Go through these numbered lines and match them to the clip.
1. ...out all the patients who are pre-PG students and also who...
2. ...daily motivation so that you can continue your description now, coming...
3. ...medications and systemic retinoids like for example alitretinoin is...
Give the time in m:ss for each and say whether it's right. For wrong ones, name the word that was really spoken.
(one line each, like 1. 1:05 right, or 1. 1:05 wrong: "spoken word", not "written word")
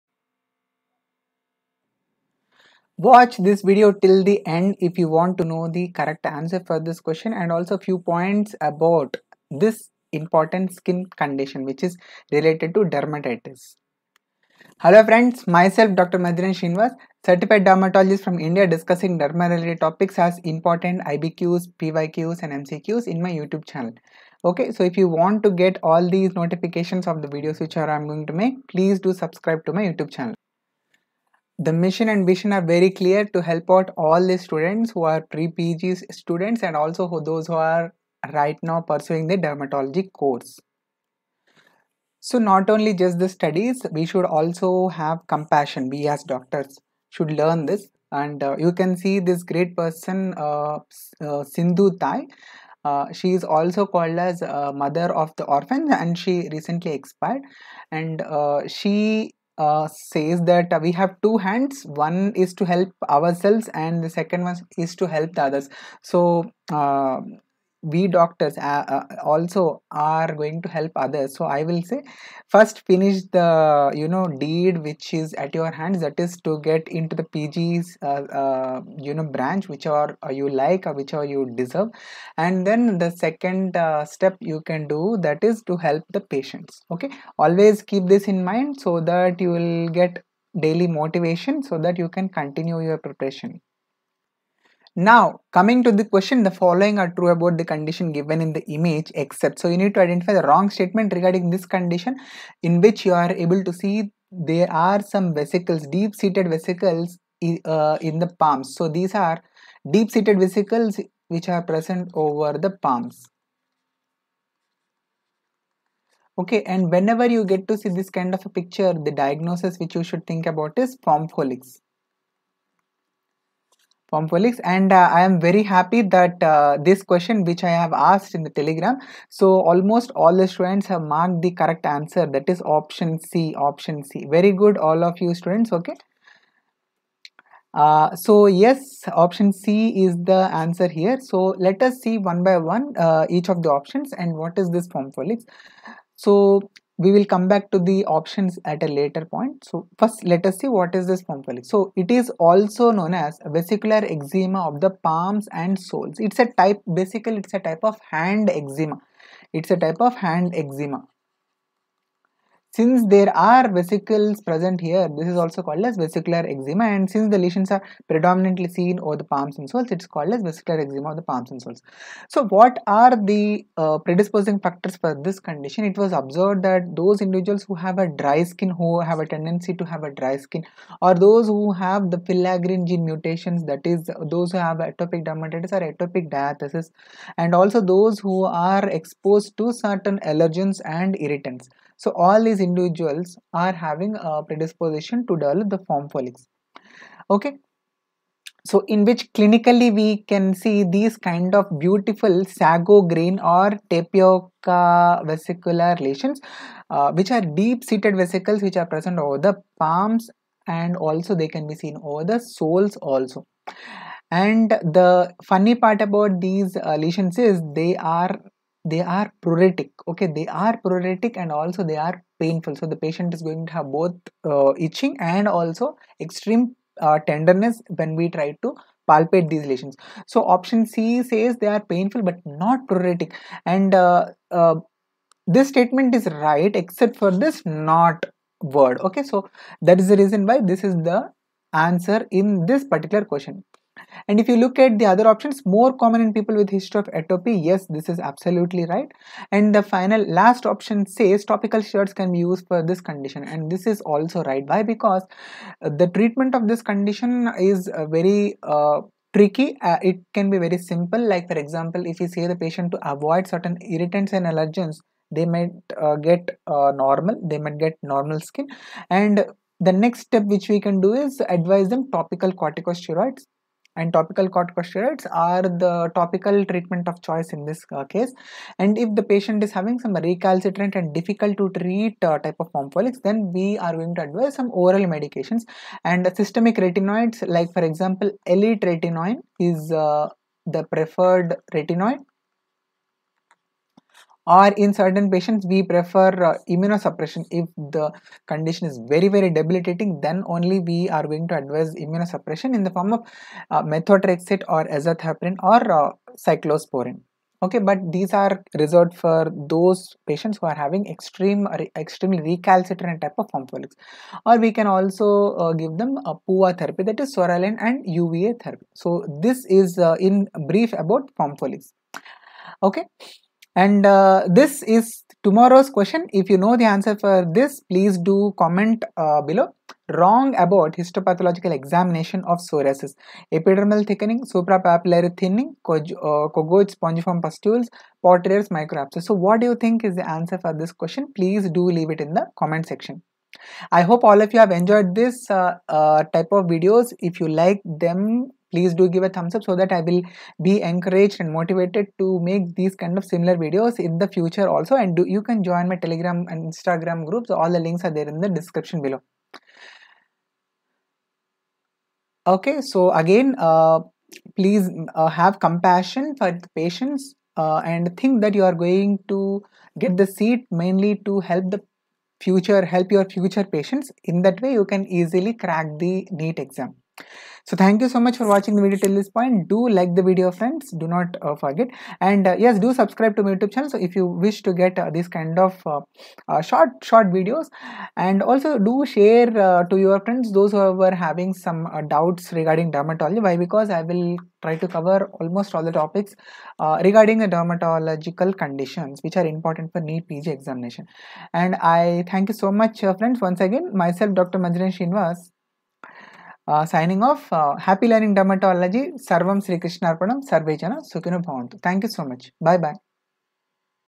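1. 0:33 wrong: "students", not "patients"
2. 1:30 wrong: "preparation", not "description"
3. 4:45 right.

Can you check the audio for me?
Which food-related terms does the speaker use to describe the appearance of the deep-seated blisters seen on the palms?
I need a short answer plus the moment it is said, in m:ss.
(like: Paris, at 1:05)
sago grain or tapioca, at 3:22.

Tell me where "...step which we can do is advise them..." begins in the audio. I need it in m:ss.
4:30.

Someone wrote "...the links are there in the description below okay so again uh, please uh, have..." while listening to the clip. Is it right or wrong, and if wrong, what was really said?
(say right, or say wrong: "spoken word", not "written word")
right.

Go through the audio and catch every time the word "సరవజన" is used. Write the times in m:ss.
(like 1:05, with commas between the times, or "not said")
6:50.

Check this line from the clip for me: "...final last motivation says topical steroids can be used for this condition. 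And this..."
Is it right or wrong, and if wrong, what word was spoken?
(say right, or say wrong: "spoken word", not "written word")
wrong: "option", not "motivation".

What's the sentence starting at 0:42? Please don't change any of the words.
So not only just the studies, we should also have compassion.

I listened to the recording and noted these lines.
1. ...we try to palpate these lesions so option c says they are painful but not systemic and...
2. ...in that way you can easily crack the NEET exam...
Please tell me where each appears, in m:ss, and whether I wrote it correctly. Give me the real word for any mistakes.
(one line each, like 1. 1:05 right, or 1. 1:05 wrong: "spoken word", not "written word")
1. 3:48 wrong: "pruritic", not "systemic"
2. 6:14 right.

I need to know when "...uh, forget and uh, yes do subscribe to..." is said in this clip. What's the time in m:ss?
6:21.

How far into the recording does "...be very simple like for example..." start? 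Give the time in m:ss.
4:20.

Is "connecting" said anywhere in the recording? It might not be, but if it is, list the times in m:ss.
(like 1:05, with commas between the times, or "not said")
not said.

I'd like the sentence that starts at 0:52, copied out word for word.
Uh, she is also called as uh, mother of the orphans and she recently expired.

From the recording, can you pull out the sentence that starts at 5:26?
If you know the answer for this, please do comment uh, below.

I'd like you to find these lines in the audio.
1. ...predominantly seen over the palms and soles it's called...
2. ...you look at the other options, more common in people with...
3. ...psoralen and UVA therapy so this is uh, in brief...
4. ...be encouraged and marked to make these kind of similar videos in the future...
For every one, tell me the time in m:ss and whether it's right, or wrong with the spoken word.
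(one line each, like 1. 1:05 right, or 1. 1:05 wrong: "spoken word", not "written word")
1. 2:48 right
2. 4:04 right
3. 5:17 right
4. 5:50 wrong: "motivated", not "marked".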